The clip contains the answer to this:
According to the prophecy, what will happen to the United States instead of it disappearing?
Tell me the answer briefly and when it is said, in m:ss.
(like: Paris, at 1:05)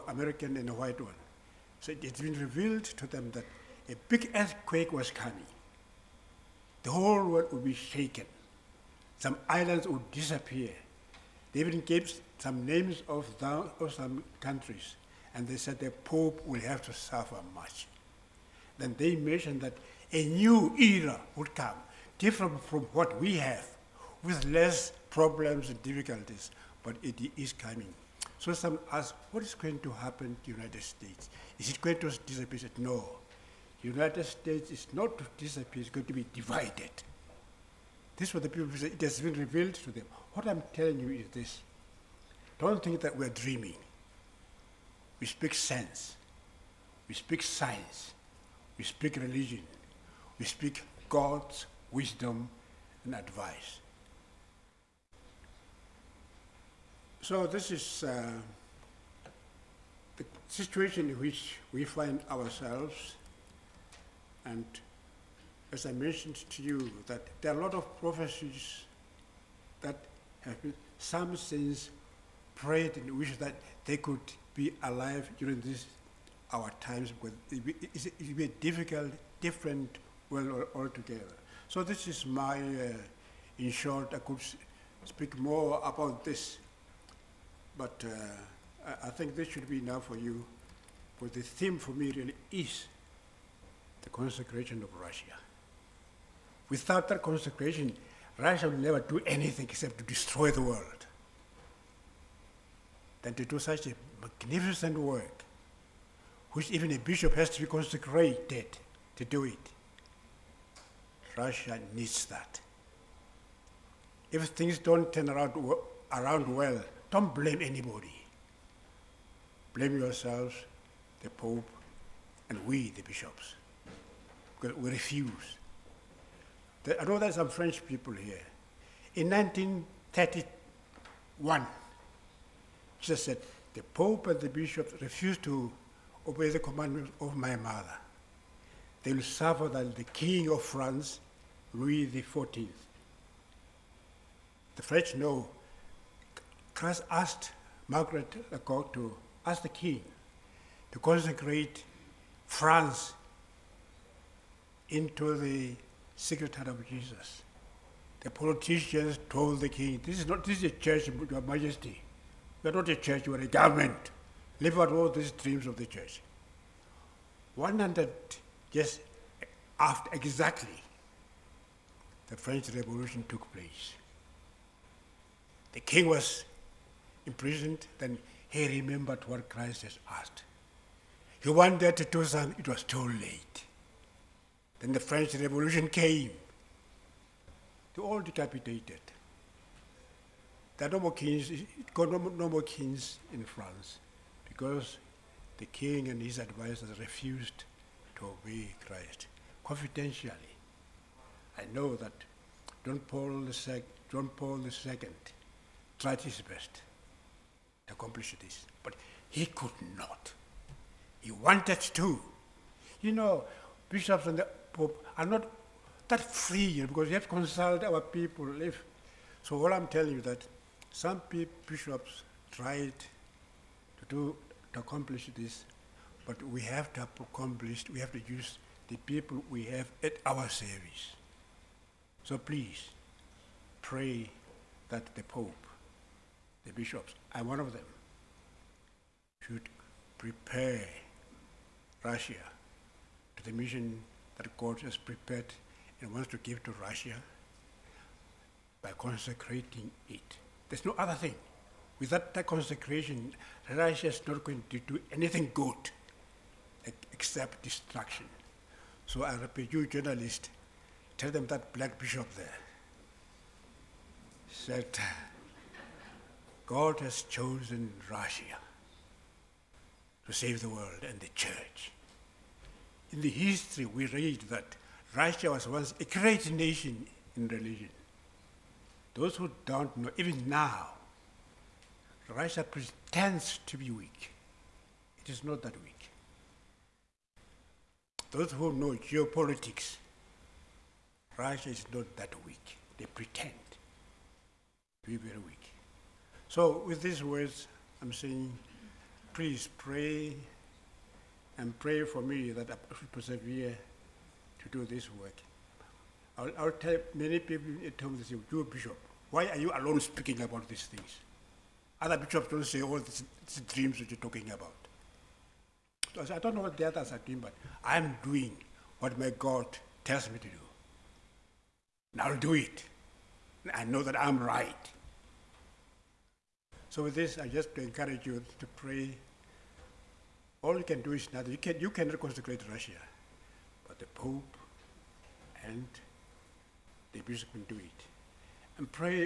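Divided, at 0:36.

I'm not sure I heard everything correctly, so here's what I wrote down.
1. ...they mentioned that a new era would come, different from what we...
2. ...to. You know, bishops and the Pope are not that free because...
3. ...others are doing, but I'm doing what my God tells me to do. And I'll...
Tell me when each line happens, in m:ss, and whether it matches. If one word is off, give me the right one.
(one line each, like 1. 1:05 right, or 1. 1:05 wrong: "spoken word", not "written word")
1. 0:18 right
2. 3:31 right
3. 5:16 right.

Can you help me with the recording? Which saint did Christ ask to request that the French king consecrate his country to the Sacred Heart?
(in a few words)
Margaret Alacoque.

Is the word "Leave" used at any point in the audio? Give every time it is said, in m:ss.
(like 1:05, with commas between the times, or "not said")
2:44.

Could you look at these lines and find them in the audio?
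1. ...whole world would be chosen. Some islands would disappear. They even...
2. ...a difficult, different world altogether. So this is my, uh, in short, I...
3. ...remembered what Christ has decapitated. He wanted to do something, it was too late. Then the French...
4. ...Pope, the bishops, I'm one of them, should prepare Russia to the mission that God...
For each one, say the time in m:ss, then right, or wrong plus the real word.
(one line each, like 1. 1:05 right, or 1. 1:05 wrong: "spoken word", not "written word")
1. 0:06 wrong: "shaken", not "chosen"
2. 1:18 right
3. 2:58 wrong: "asked", not "decapitated"
4. 3:55 right.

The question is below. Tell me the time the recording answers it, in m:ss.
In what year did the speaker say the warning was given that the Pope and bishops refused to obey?
2:09.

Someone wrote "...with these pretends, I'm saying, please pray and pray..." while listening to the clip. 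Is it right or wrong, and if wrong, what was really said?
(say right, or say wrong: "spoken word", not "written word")
wrong: "words", not "pretends".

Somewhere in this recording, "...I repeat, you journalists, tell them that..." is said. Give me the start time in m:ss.
4:19.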